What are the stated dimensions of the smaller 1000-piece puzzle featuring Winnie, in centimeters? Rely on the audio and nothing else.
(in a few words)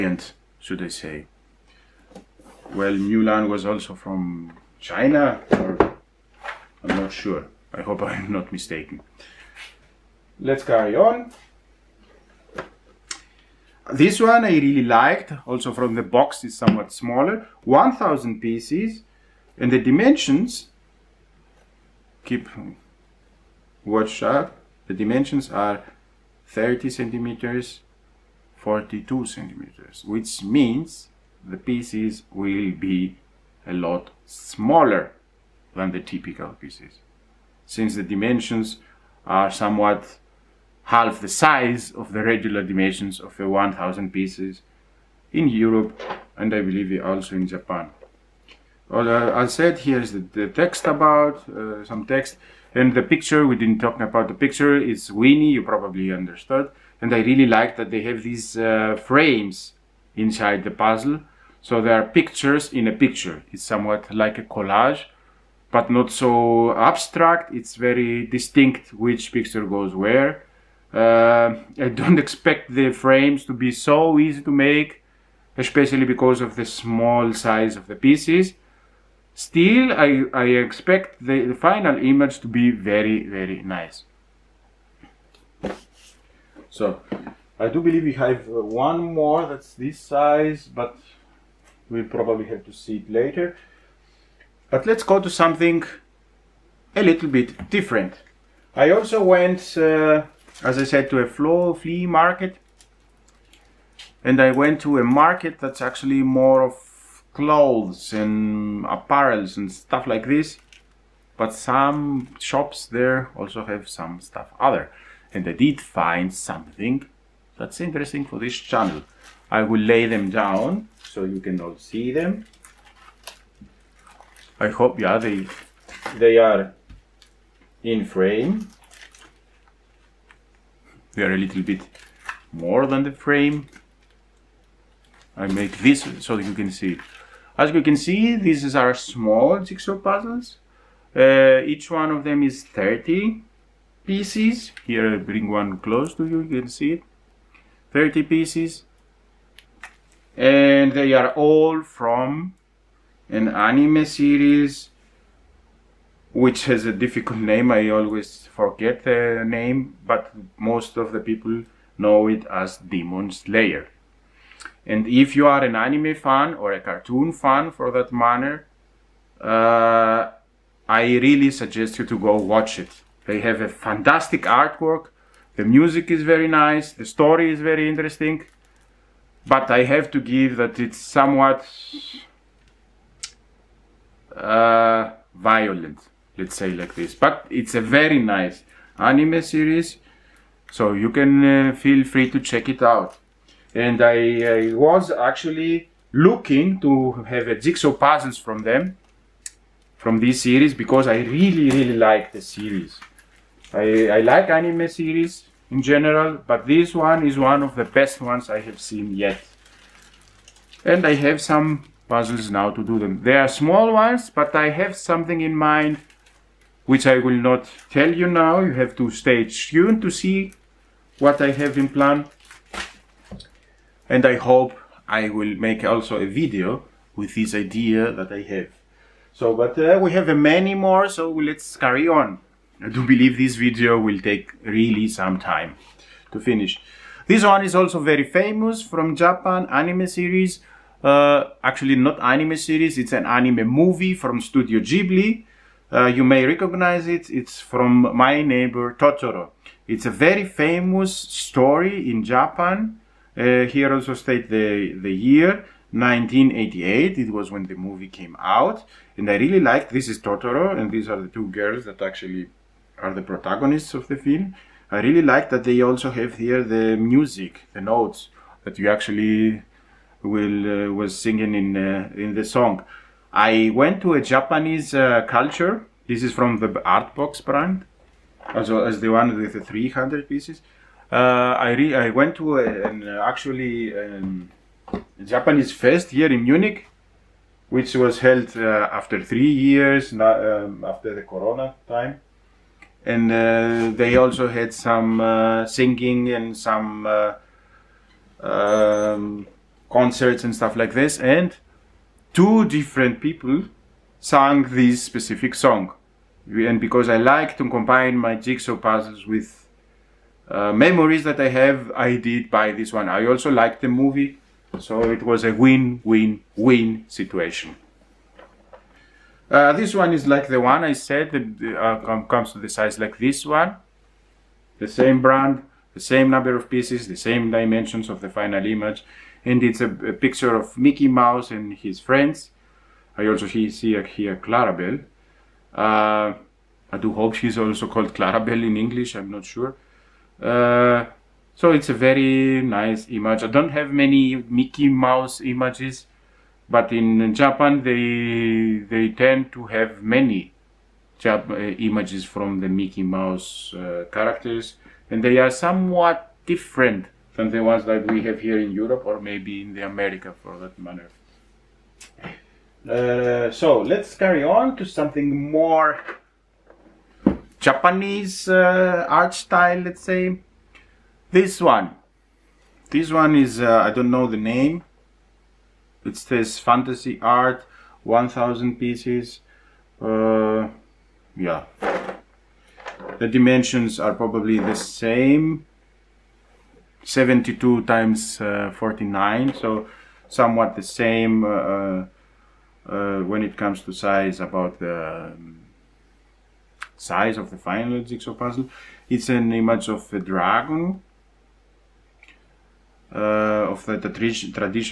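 30 by 42 centimeters.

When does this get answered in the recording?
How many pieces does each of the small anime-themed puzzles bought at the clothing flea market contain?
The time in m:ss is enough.
2:22.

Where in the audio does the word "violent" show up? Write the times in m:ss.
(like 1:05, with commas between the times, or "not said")
3:05.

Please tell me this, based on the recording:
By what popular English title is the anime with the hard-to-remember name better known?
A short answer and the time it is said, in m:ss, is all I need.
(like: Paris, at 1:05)
Demon Slayer, at 2:42.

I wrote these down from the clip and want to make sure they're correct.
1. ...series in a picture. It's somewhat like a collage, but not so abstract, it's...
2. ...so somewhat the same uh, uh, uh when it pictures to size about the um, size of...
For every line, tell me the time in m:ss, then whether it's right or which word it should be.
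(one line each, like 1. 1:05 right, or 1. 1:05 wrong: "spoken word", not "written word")
1. 1:02 wrong: "pictures", not "series"
2. 6:29 wrong: "comes", not "pictures".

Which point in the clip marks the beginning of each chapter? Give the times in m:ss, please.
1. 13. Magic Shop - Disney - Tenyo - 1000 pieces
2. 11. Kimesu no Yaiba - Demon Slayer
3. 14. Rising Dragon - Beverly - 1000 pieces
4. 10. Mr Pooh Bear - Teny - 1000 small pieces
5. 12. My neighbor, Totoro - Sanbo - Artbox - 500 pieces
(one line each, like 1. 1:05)
1. 5:19
2. 1:58
3. 6:10
4. 0:12
5. 3:57.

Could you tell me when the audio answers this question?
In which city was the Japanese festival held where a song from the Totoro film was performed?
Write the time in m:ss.
4:46.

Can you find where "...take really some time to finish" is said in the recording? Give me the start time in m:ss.
3:54.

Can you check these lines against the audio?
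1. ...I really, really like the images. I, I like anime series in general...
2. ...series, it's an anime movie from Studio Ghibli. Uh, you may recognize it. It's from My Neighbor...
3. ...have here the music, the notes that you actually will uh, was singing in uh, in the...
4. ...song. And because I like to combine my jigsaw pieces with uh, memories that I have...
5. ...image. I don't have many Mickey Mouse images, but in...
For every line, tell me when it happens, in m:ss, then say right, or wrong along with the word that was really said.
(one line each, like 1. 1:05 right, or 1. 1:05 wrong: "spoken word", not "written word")
1. 3:21 wrong: "series", not "images"
2. 4:02 right
3. 4:26 right
4. 5:05 wrong: "puzzles", not "pieces"
5. 5:43 right.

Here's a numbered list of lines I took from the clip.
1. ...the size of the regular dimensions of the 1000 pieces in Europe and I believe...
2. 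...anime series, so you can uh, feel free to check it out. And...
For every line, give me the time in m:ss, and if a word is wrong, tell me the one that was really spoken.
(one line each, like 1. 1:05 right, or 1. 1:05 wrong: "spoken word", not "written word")
1. 0:41 right
2. 3:08 right.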